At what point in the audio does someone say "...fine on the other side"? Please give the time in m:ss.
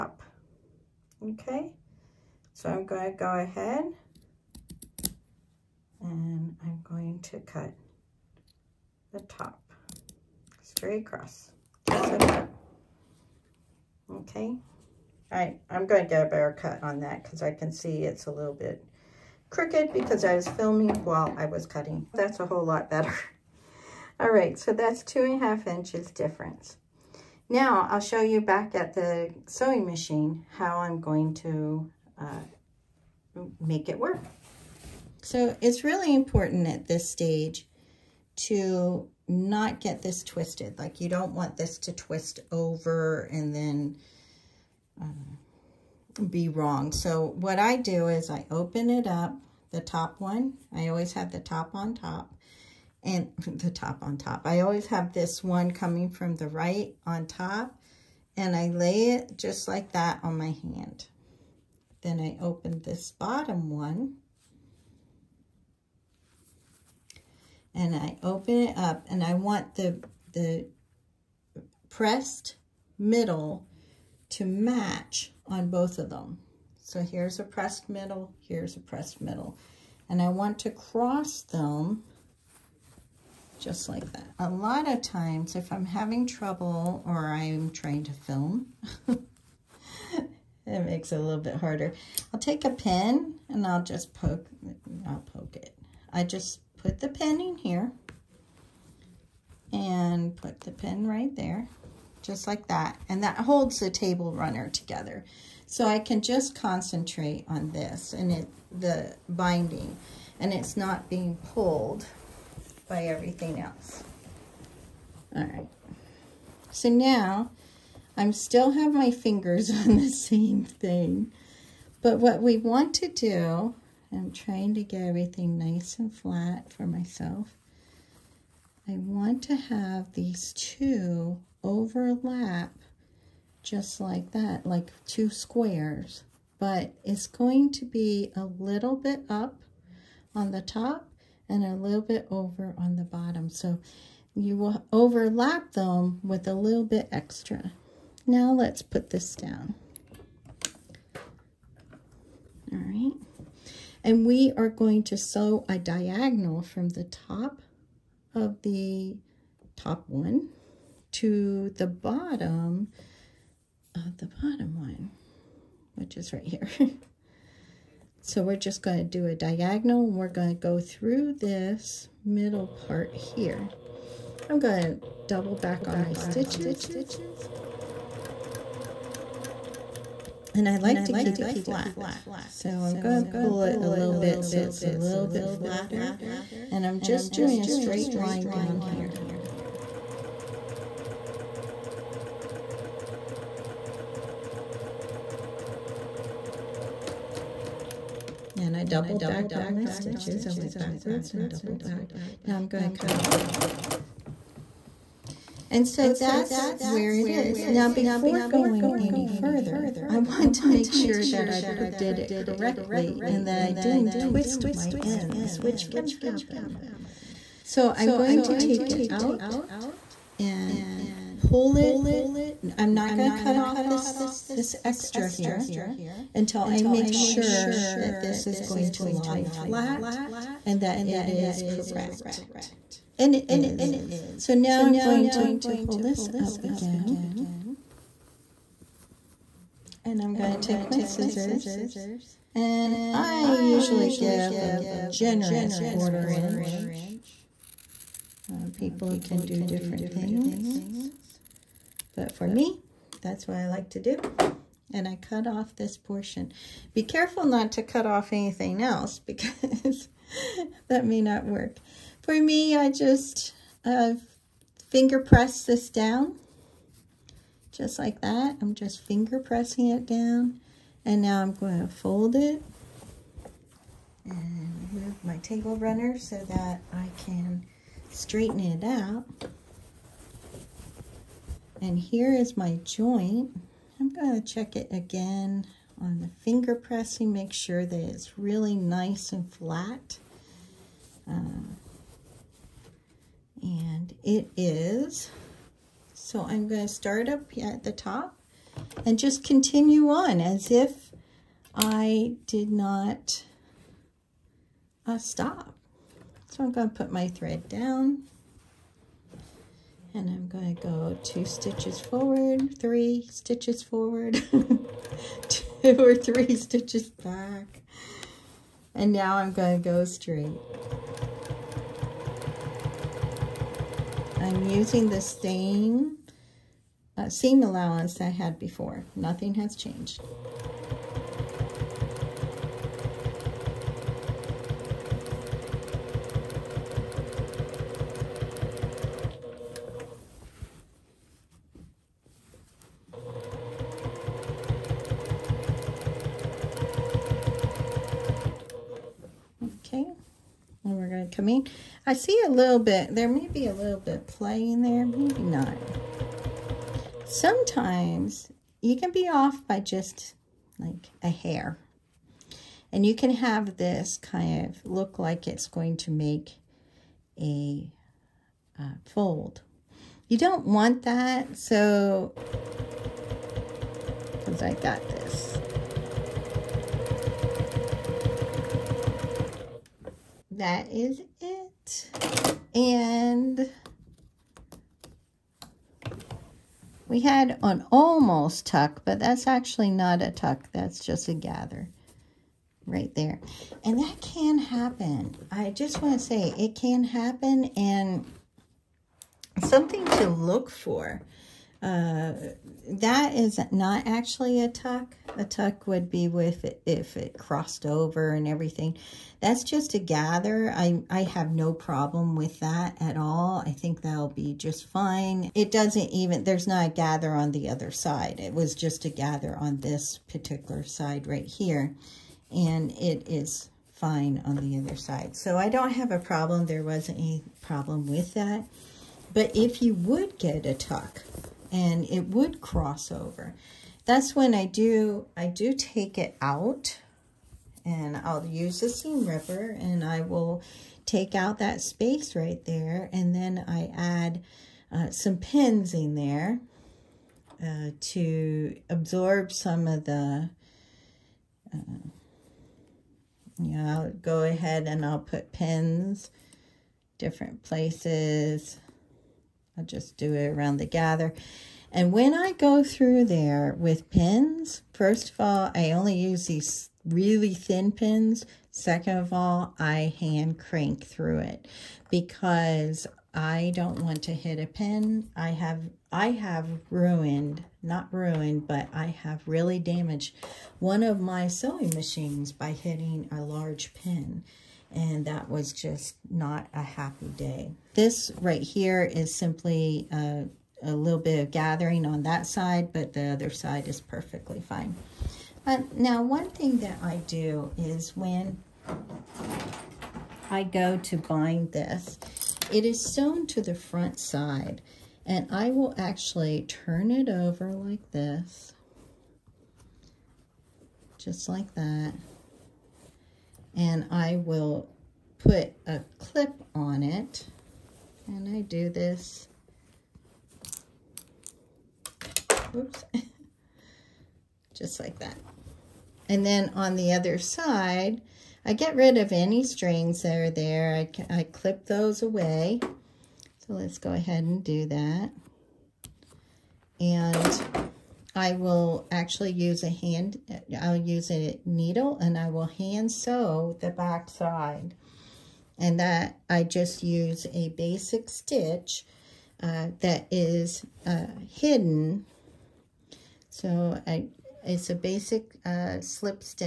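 7:03.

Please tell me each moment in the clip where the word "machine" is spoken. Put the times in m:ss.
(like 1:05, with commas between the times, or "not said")
0:29, 8:01.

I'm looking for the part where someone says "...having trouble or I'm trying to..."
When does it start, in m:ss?
1:25.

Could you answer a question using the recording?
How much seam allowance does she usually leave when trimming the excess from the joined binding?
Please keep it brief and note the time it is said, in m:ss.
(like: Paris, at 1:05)
generous quarter inch, at 4:05.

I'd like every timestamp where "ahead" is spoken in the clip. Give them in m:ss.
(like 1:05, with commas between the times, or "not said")
0:03, 7:34, 8:54.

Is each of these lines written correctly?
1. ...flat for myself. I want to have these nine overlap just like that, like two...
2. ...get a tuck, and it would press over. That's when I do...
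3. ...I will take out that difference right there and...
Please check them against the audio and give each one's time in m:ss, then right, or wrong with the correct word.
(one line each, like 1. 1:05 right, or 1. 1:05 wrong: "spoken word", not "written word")
1. 2:06 wrong: "two", not "nine"
2. 7:10 wrong: "cross", not "press"
3. 7:20 wrong: "space", not "difference".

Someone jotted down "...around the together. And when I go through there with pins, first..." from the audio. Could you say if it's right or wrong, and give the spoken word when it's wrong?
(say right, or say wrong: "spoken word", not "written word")
wrong: "gather", not "together".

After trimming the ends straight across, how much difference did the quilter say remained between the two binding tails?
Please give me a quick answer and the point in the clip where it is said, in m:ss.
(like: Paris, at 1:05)
2.5 inches, at 0:25.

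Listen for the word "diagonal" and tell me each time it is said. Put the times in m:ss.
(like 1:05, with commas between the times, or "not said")
2:35, 2:49.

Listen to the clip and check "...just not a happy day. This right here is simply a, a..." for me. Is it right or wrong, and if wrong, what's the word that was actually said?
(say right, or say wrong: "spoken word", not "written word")
right.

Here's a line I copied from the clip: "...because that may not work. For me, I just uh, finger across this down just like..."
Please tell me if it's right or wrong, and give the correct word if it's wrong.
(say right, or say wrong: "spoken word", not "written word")
wrong: "press", not "across".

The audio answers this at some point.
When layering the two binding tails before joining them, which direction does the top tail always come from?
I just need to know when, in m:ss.
0:56.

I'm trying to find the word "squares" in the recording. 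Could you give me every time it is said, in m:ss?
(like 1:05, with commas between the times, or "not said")
2:15.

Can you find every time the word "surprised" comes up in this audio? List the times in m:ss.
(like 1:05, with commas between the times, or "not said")
not said.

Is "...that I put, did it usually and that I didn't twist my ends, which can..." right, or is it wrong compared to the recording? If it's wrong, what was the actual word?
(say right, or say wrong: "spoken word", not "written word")
wrong: "correctly", not "usually".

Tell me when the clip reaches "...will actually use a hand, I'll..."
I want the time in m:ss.
8:58.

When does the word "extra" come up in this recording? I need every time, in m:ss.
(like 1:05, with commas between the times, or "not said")
2:27, 3:44.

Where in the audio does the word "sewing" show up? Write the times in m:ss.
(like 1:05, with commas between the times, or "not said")
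0:29, 8:01.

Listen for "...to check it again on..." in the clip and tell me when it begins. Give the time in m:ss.
4:44.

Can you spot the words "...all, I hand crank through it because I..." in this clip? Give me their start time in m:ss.
7:49.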